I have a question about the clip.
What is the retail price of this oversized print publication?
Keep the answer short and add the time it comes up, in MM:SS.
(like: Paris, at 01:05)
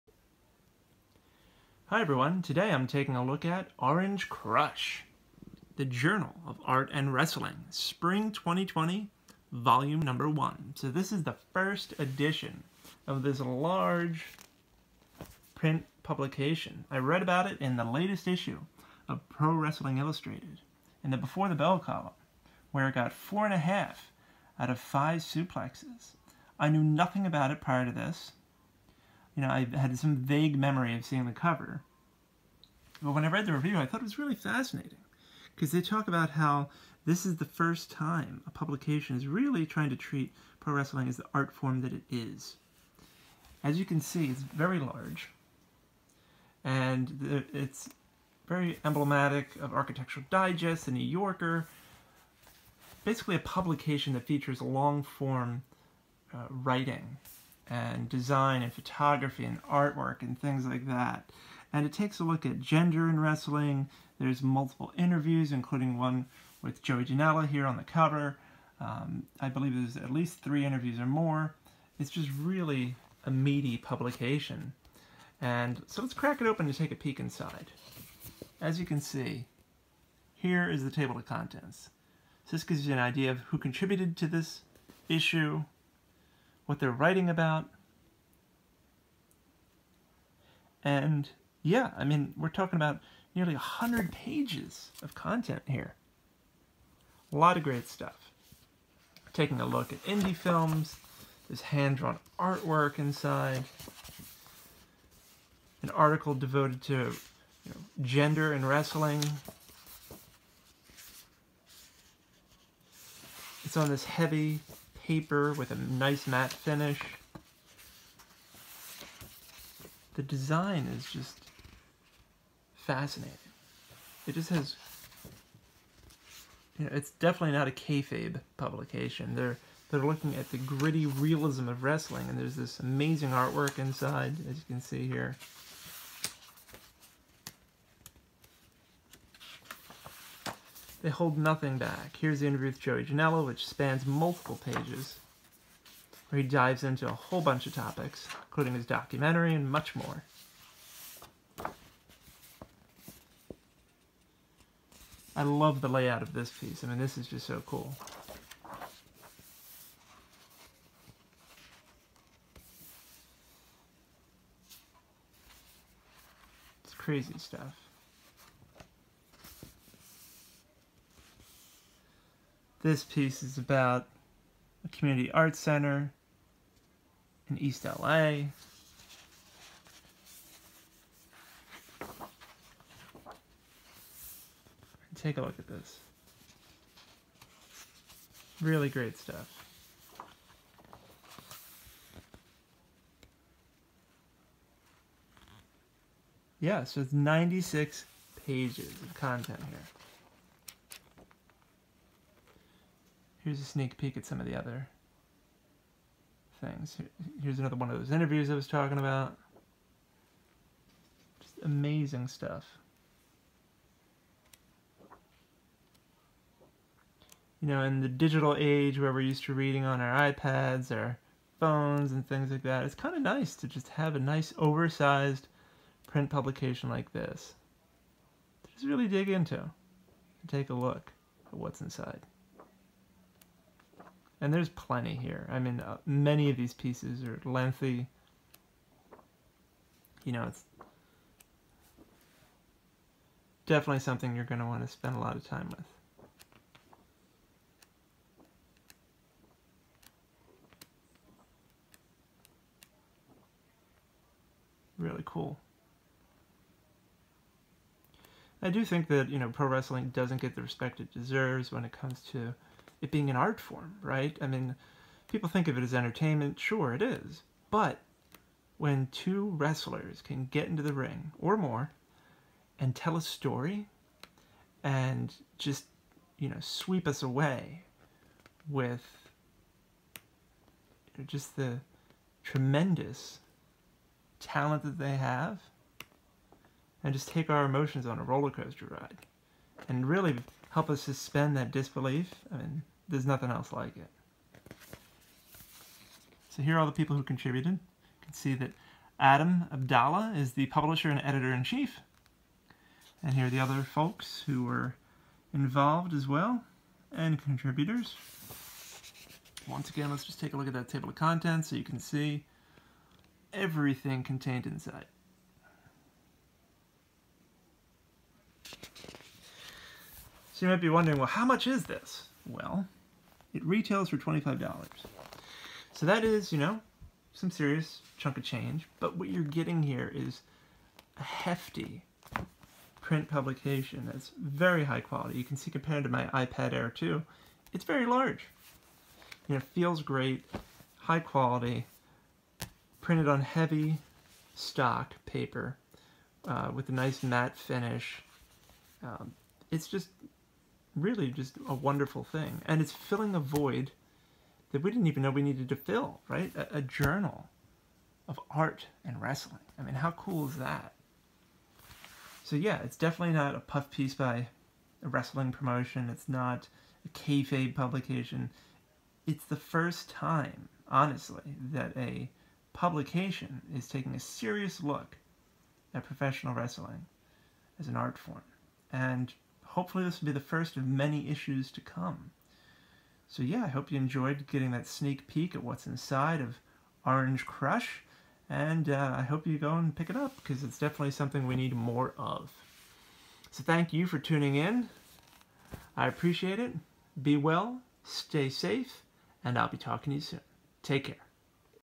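$25, at 05:24.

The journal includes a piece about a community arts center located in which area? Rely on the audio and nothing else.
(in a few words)
East LA.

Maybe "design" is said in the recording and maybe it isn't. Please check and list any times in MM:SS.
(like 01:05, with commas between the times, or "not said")
00:58, 02:00.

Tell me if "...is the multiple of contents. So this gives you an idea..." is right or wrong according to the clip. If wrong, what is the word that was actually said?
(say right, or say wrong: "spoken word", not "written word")
wrong: "table", not "multiple".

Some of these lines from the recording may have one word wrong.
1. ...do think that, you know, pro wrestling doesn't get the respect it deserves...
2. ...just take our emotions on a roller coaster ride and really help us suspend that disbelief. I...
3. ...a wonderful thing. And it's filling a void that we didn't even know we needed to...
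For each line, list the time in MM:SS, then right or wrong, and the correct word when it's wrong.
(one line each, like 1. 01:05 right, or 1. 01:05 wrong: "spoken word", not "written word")
1. 04:18 right
2. 04:47 right
3. 05:51 right.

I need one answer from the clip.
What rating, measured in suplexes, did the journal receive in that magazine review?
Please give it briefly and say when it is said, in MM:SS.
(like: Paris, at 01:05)
4.5 out of 5, at 00:23.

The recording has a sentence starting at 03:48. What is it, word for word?
To just really dig into and take a look at what's inside.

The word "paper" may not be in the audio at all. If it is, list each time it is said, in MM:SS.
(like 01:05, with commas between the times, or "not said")
01:55, 05:45.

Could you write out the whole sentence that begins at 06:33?
So thank you for tuning in.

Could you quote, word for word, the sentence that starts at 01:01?
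And it takes a look at gender in wrestling.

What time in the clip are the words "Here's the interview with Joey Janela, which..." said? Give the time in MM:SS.
02:22.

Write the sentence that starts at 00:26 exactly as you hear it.
I knew nothing about it prior to this, you know, I had some vague memory of seeing the cover.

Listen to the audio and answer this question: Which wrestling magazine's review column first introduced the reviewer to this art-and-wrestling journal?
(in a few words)
Pro Wrestling Illustrated.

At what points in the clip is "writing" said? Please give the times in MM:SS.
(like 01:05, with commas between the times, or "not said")
00:56, 01:26.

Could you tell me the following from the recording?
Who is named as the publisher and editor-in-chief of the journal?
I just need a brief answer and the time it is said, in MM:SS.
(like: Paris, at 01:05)
Adam Abdallah, at 04:59.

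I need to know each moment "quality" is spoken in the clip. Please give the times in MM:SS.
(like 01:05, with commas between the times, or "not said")
05:35, 05:41.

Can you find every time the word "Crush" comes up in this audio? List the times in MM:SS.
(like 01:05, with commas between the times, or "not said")
00:04, 06:27.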